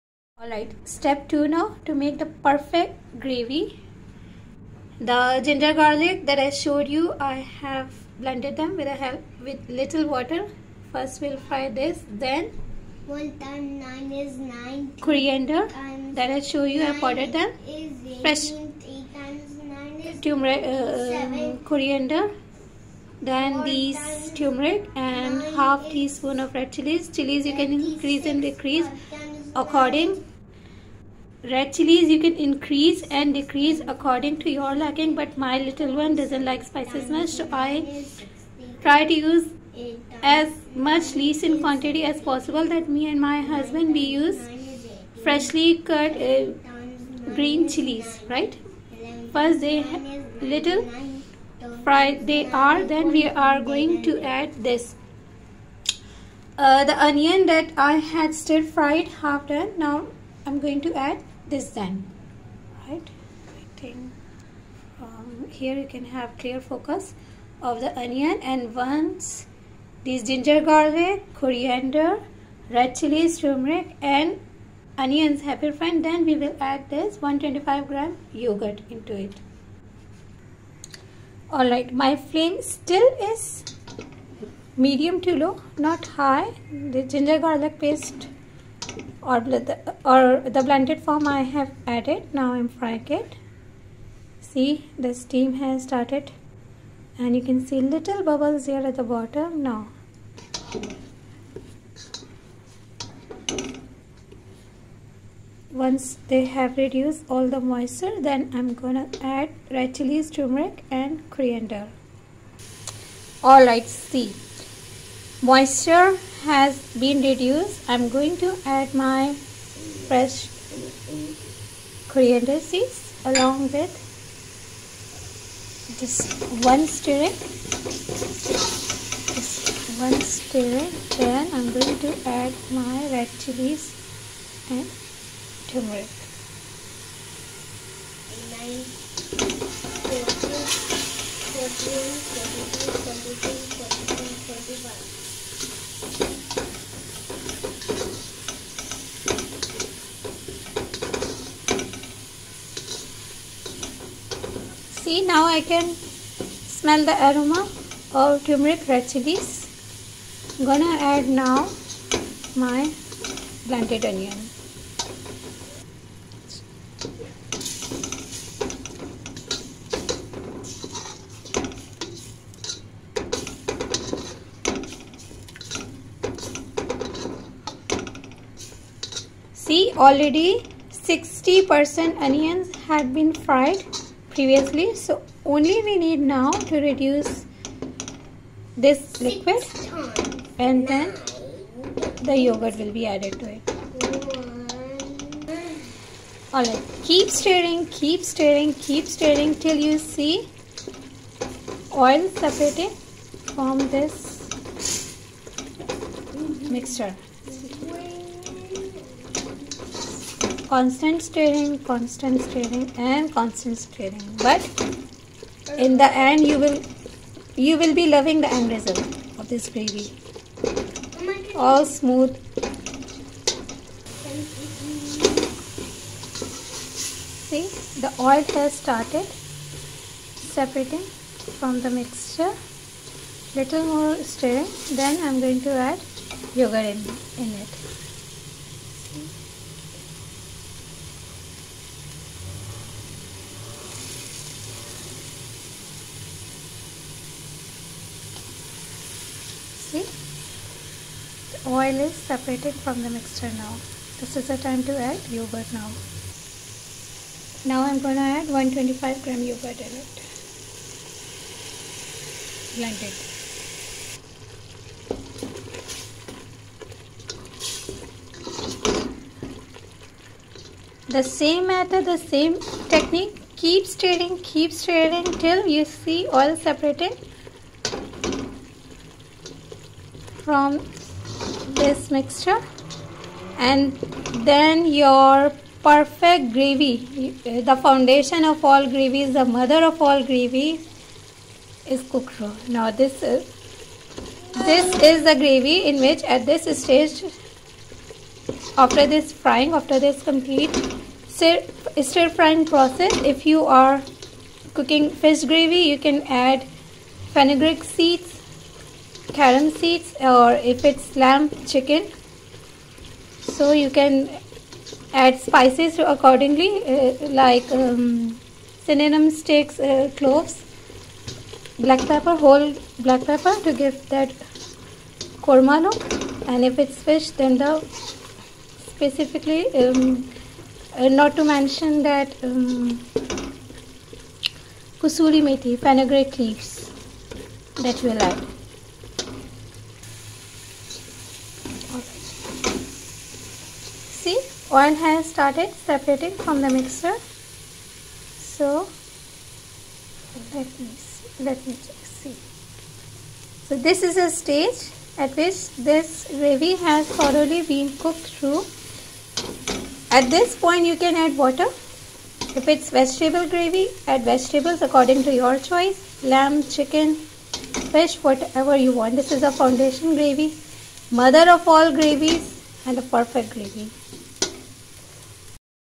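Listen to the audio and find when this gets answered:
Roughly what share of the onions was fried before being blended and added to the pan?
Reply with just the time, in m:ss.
3:00.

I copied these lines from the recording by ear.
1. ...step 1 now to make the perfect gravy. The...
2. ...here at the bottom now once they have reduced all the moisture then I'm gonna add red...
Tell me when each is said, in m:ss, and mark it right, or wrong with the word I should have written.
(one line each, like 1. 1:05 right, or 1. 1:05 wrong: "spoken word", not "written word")
1. 0:00 wrong: "2", not "1"
2. 1:38 right.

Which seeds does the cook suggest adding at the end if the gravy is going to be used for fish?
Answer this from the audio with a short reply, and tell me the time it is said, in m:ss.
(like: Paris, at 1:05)
fenugreek seeds, at 5:07.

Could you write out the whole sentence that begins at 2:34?
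See now I can smell the aroma of turmeric red chilies.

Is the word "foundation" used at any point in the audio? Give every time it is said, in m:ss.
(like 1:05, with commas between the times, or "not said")
4:47, 6:09.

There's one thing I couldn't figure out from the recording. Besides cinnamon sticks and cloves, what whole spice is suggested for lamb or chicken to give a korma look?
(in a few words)
whole black pepper.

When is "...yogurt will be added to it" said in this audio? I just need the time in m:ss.
3:12.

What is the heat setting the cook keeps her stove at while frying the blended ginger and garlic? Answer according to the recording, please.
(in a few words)
medium to low.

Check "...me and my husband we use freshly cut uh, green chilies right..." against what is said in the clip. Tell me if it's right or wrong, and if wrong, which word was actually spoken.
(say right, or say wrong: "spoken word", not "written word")
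right.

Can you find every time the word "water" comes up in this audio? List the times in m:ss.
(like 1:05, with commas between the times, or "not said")
0:10, 6:01.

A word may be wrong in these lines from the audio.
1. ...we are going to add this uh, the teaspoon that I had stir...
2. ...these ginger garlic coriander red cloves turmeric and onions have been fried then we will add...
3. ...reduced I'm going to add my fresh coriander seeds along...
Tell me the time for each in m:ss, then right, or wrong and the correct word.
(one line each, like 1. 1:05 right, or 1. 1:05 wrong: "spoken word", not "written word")
1. 0:53 wrong: "onion", not "teaspoon"
2. 1:10 wrong: "chilies", not "cloves"
3. 1:57 right.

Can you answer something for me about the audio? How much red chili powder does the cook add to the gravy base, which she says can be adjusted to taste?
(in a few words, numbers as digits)
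half teaspoon.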